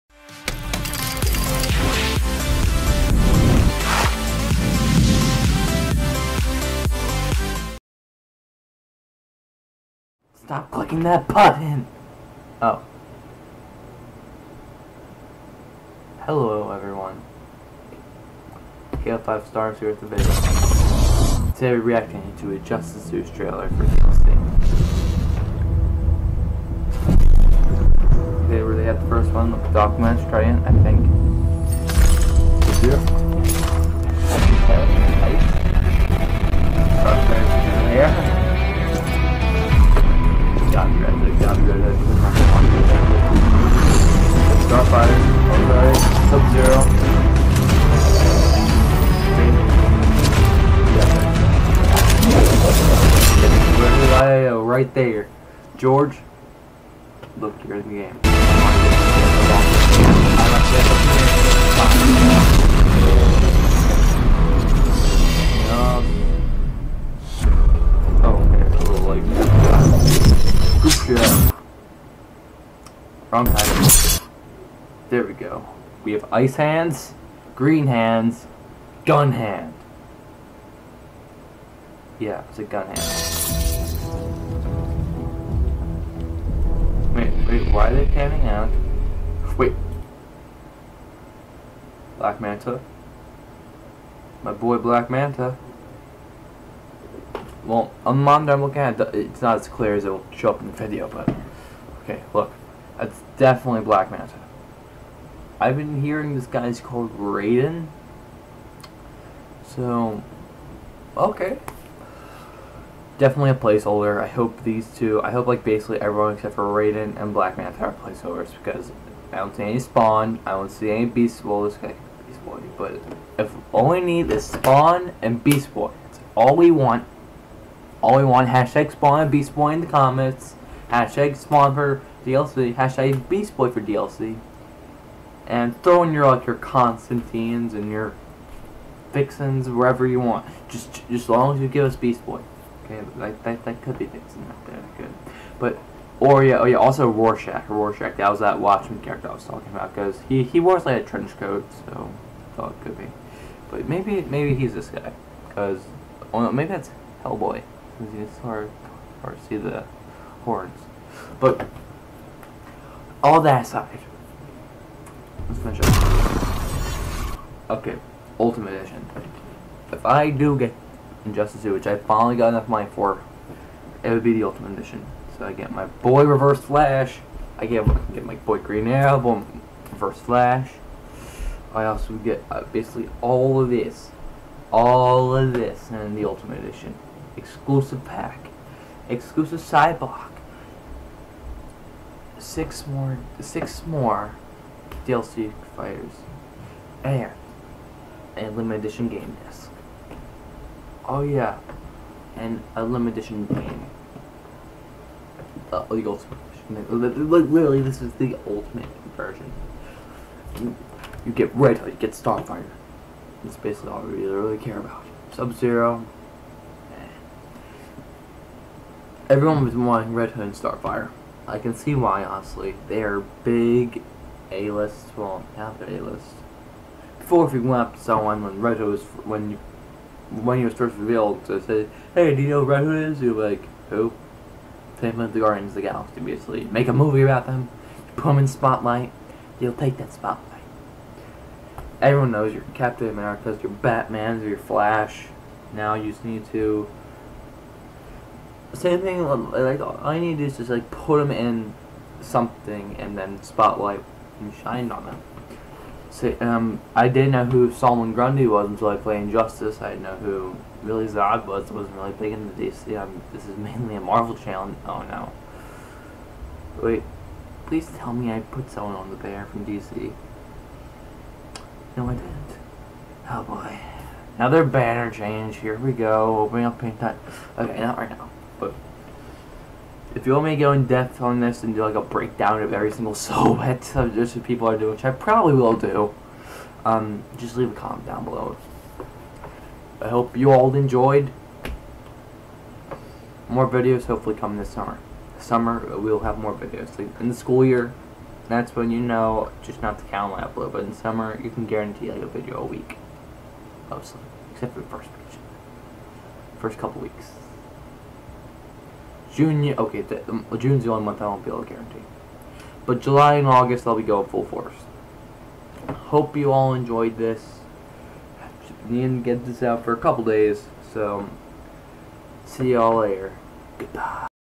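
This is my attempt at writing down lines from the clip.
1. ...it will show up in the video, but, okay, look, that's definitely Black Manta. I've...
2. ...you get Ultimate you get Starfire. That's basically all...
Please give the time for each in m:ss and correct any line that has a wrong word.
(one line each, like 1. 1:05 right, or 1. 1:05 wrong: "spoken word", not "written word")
1. 1:40 right
2. 3:31 wrong: "Red", not "Ultimate".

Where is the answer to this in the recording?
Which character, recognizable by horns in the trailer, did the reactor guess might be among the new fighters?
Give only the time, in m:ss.
2:37.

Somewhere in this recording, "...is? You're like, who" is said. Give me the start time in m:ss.
3:53.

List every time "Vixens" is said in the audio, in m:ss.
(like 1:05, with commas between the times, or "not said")
2:19, 2:24.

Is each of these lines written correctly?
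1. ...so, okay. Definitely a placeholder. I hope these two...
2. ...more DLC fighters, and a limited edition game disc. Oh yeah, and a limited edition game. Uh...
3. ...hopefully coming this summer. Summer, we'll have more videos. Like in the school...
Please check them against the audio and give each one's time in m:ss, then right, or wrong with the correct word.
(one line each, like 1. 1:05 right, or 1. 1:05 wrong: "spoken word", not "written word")
1. 1:49 right
2. 3:13 right
3. 4:54 right.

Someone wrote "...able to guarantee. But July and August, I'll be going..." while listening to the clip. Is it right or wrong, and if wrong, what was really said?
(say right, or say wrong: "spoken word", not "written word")
right.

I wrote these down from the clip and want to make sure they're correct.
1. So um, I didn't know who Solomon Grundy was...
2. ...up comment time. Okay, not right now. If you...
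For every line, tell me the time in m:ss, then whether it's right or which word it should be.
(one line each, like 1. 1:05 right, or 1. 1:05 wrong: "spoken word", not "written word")
1. 4:16 right
2. 4:36 wrong: "paint", not "comment".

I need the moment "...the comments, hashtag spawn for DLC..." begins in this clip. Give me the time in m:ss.
2:09.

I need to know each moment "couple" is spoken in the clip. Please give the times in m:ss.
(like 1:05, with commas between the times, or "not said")
5:06, 5:19.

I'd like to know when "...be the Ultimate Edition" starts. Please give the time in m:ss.
2:54.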